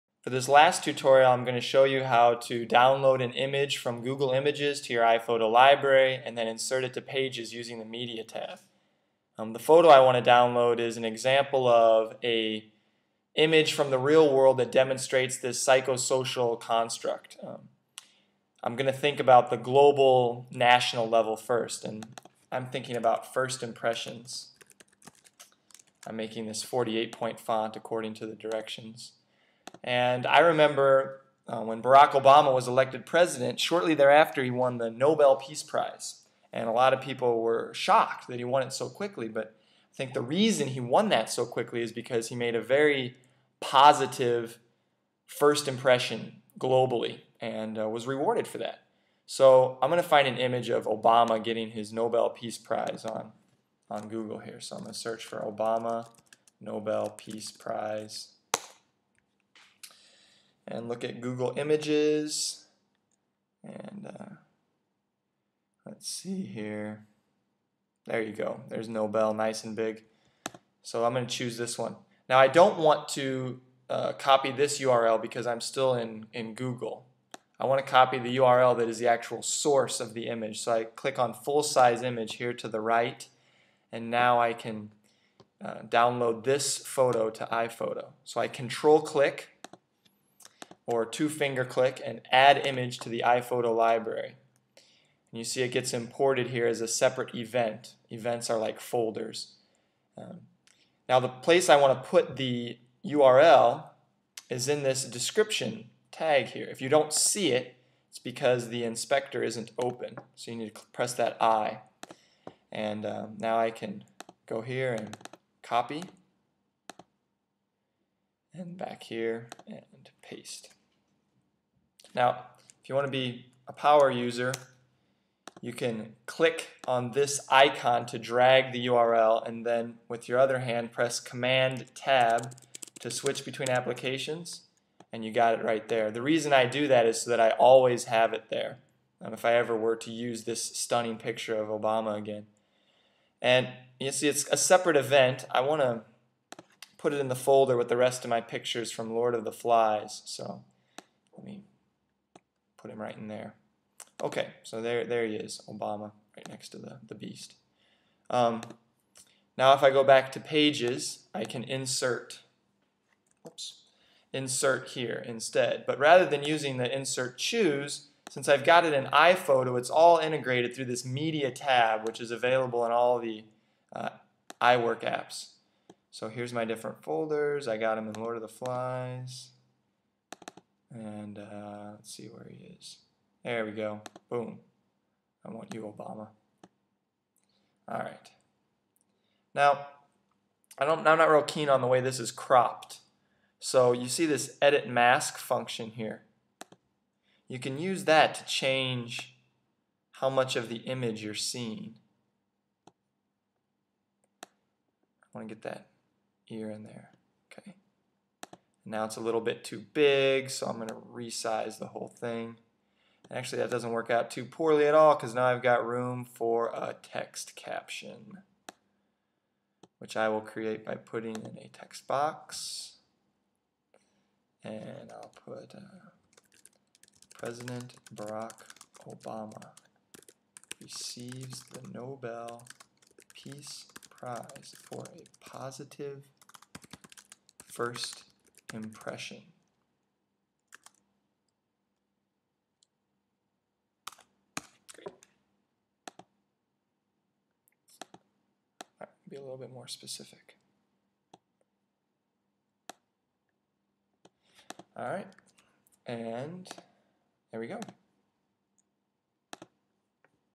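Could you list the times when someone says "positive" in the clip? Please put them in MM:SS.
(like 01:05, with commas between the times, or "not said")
00:43, 03:55.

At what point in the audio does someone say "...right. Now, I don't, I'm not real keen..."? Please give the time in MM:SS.
03:07.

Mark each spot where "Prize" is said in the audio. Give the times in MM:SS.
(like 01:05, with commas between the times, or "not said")
00:35, 00:52, 00:57, 03:54.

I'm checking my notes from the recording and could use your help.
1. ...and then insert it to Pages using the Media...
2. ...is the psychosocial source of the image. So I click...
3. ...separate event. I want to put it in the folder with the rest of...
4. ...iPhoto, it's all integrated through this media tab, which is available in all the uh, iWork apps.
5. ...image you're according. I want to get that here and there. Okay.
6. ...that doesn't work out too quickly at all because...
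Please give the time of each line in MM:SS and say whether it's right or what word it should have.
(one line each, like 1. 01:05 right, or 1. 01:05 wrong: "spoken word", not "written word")
1. 00:06 right
2. 01:18 wrong: "actual", not "psychosocial"
3. 02:24 right
4. 02:49 right
5. 03:20 wrong: "seeing", not "according"
6. 03:33 wrong: "poorly", not "quickly".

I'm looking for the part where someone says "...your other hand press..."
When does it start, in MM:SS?
02:10.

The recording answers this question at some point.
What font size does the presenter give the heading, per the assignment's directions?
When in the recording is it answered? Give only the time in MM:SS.
00:26.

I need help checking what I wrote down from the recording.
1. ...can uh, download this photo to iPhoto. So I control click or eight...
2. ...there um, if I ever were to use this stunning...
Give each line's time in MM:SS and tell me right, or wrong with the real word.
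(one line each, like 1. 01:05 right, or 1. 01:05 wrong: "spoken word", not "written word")
1. 01:24 wrong: "two", not "eight"
2. 02:18 right.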